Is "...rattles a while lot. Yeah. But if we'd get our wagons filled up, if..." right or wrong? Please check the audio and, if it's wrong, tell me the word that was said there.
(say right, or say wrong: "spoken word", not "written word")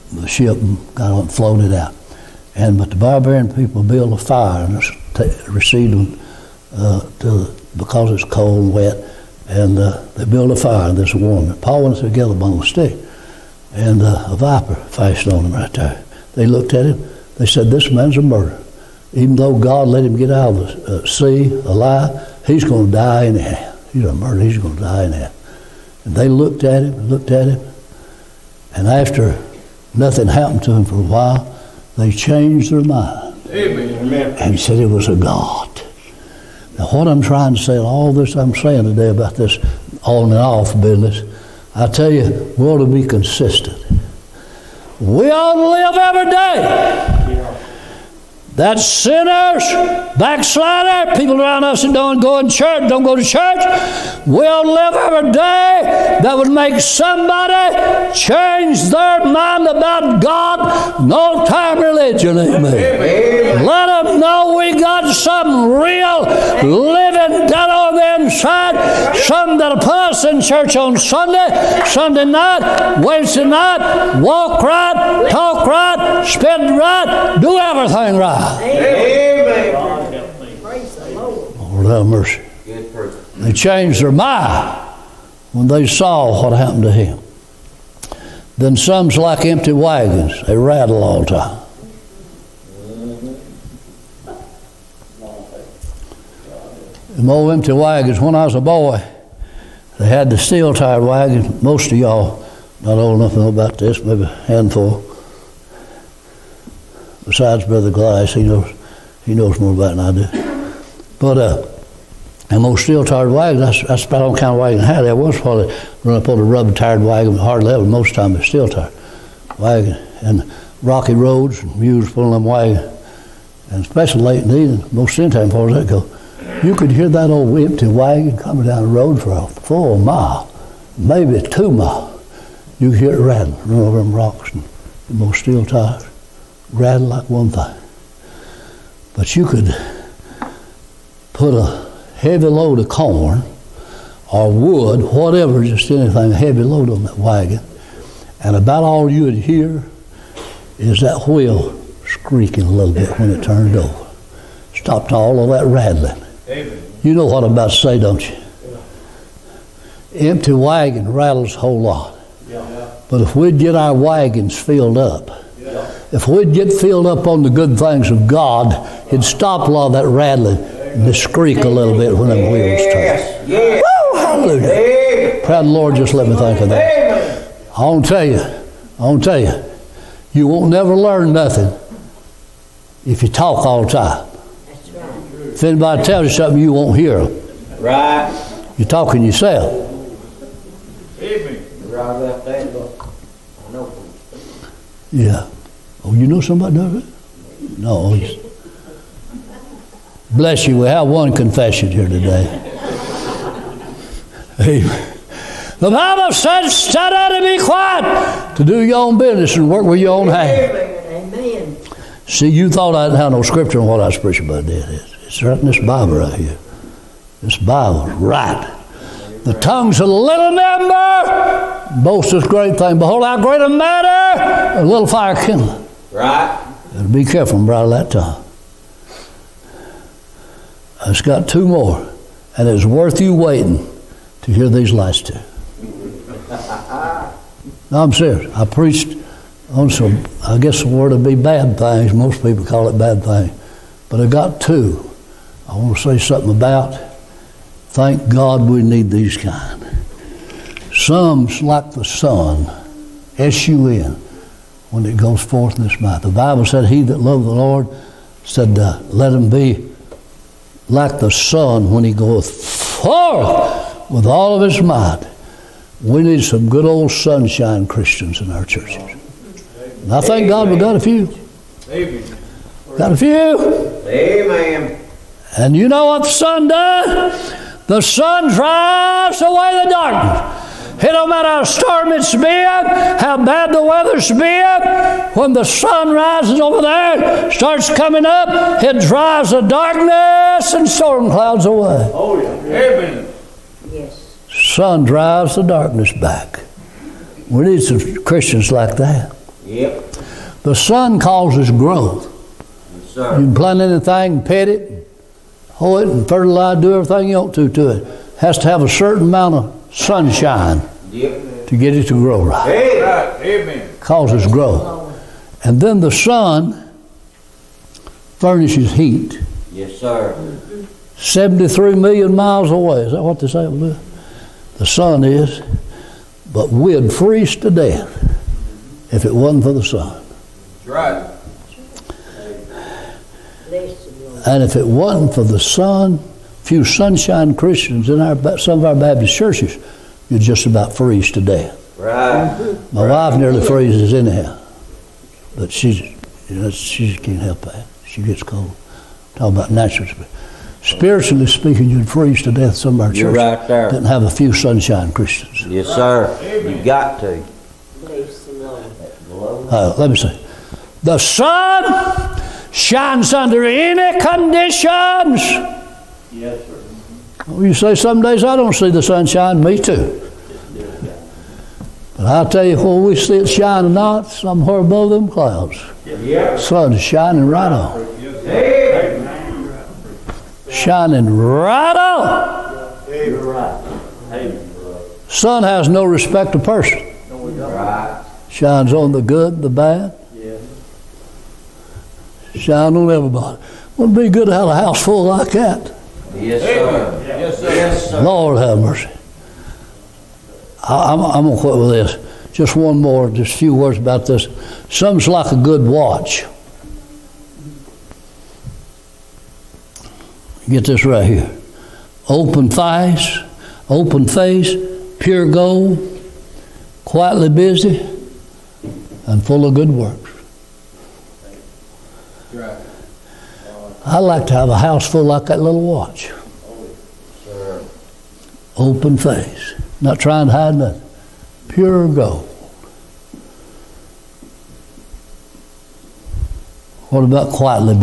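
wrong: "whole", not "while".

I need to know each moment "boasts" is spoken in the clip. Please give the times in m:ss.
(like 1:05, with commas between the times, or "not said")
3:42.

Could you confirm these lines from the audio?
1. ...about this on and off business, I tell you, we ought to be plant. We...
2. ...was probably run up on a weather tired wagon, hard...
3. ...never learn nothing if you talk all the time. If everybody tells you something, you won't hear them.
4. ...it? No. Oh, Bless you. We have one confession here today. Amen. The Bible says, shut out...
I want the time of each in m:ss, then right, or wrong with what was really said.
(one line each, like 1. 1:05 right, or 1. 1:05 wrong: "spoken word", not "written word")
1. 0:39 wrong: "consistent", not "plant"
2. 1:55 wrong: "rubber", not "weather"
3. 3:00 wrong: "anybody", not "everybody"
4. 3:16 right.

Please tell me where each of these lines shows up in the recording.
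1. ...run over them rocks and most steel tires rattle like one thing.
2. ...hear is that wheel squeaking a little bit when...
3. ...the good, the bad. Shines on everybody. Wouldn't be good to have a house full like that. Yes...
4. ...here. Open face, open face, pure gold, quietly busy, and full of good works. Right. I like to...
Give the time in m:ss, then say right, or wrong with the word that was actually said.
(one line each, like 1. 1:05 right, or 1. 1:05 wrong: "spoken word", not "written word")
1. 2:13 right
2. 2:29 right
3. 6:29 right
4. 6:51 right.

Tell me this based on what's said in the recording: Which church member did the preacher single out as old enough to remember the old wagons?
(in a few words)
Brother Glass.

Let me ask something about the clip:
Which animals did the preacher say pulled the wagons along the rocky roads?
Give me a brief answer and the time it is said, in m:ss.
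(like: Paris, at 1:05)
Mules, at 2:01.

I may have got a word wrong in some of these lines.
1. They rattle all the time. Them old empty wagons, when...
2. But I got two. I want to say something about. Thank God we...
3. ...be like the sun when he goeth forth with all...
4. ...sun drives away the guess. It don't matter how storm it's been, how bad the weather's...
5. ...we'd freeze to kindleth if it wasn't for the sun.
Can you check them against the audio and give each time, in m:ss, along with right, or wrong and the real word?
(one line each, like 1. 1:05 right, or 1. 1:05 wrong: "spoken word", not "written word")
1. 1:30 right
2. 4:04 right
3. 4:19 right
4. 4:37 wrong: "darkness", not "guess"
5. 5:26 wrong: "death", not "kindleth".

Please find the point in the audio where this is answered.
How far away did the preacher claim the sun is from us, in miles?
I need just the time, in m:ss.
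5:21.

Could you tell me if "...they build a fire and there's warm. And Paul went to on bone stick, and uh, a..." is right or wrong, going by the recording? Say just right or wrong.
right.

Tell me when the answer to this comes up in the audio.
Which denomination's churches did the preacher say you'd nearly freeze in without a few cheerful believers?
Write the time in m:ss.
5:38.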